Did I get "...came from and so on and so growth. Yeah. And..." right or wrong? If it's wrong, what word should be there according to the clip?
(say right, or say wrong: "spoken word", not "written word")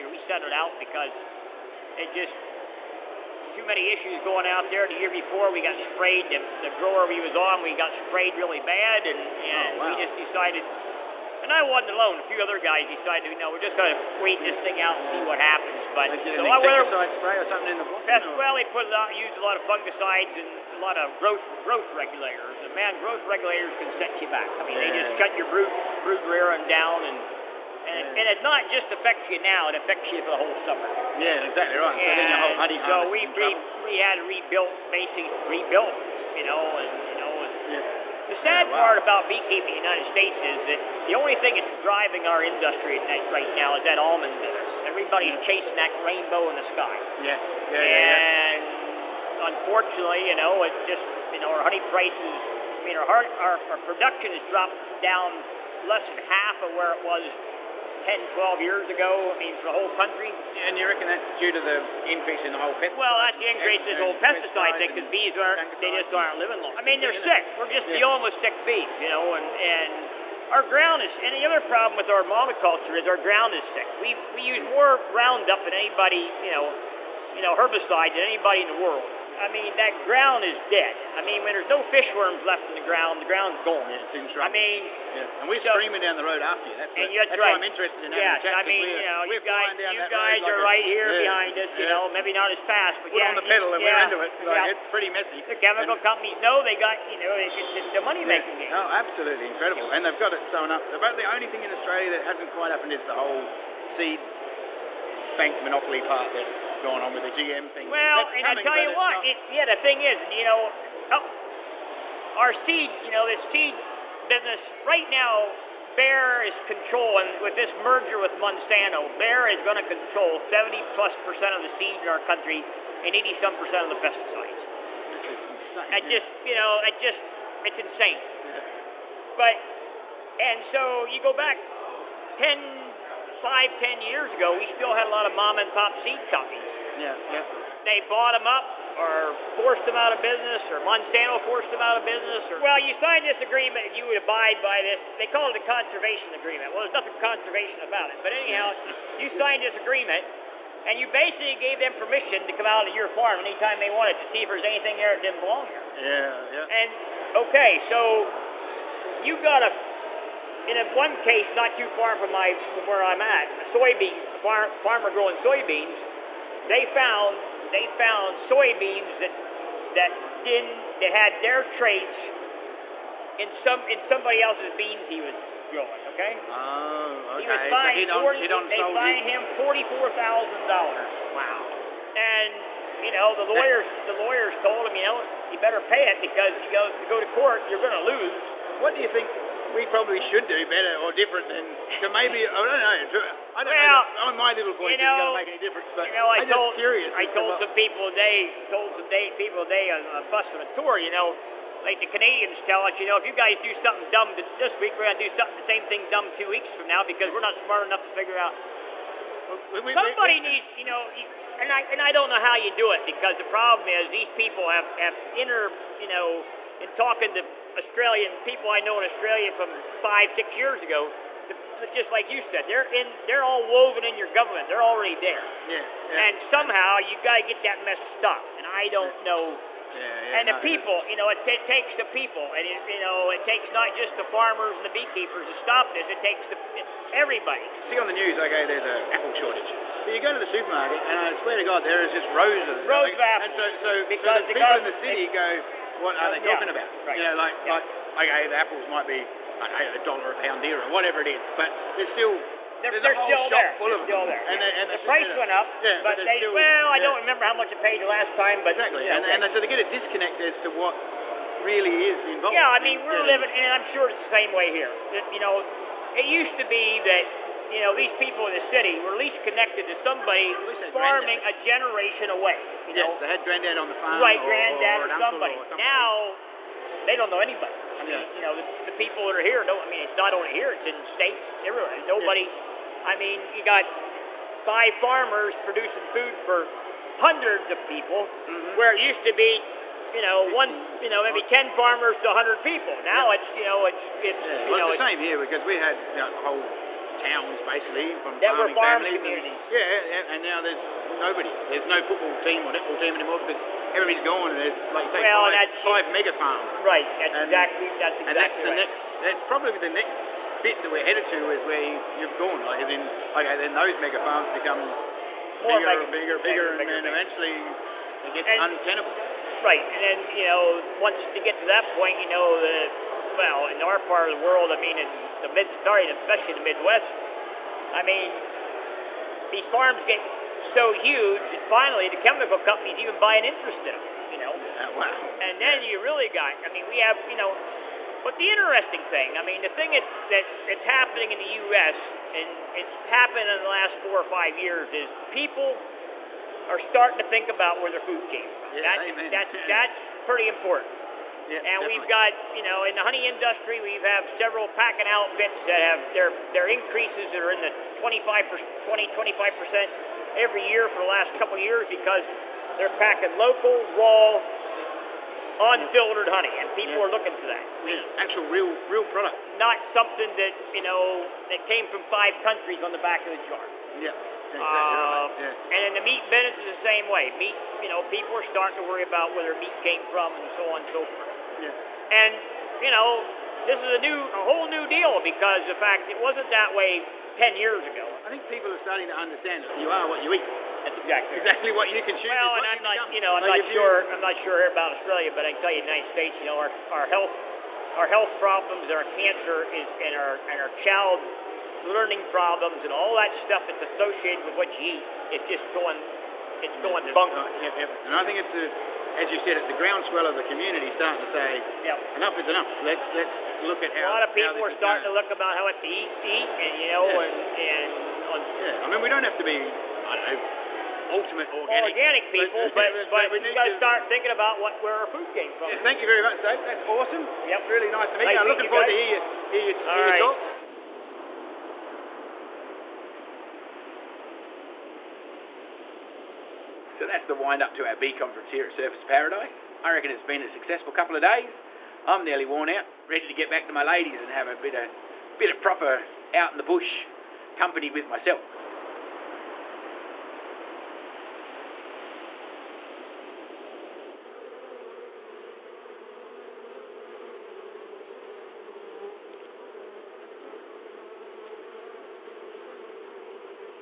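wrong: "forth", not "growth".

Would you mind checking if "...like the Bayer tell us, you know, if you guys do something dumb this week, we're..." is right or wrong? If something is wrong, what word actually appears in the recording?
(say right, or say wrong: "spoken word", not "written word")
wrong: "Canadians", not "Bayer".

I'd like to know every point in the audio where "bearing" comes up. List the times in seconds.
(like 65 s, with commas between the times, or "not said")
not said.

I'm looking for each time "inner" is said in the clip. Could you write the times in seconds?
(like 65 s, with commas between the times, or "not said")
215 s.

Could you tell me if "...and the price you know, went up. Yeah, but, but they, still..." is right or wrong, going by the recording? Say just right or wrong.
right.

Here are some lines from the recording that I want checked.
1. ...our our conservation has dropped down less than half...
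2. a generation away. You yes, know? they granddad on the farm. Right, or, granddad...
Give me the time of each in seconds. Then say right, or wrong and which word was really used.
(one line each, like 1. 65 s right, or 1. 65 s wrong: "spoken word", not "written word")
1. 53 s wrong: "production", not "conservation"
2. 271 s right.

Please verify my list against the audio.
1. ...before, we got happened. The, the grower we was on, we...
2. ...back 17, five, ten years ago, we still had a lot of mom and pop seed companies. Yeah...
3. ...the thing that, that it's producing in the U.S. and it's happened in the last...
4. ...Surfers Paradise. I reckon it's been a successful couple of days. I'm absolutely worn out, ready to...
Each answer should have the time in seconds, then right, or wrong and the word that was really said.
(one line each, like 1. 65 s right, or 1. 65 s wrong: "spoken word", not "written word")
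1. 5 s wrong: "sprayed", not "happened"
2. 131 s wrong: "10", not "17"
3. 339 s wrong: "happening", not "producing"
4. 438 s wrong: "nearly", not "absolutely".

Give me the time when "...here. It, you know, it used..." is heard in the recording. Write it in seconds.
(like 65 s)
264 s.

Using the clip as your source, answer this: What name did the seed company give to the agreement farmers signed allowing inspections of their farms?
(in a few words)
conservation agreement.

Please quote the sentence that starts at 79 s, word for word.
I mean, that ground is dead.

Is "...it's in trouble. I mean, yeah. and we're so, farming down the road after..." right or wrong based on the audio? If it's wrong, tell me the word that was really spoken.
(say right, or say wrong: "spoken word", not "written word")
wrong: "screaming", not "farming".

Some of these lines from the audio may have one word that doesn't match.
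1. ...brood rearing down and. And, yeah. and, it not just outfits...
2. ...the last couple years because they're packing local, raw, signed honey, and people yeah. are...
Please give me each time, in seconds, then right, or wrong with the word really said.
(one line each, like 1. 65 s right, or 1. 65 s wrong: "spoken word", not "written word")
1. 26 s wrong: "affects", not "outfits"
2. 360 s wrong: "unfiltered", not "signed".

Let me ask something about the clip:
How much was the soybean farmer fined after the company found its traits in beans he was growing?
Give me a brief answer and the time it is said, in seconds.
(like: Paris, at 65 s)
$44,000, at 179 s.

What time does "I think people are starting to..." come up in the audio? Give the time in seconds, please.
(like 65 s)
388 s.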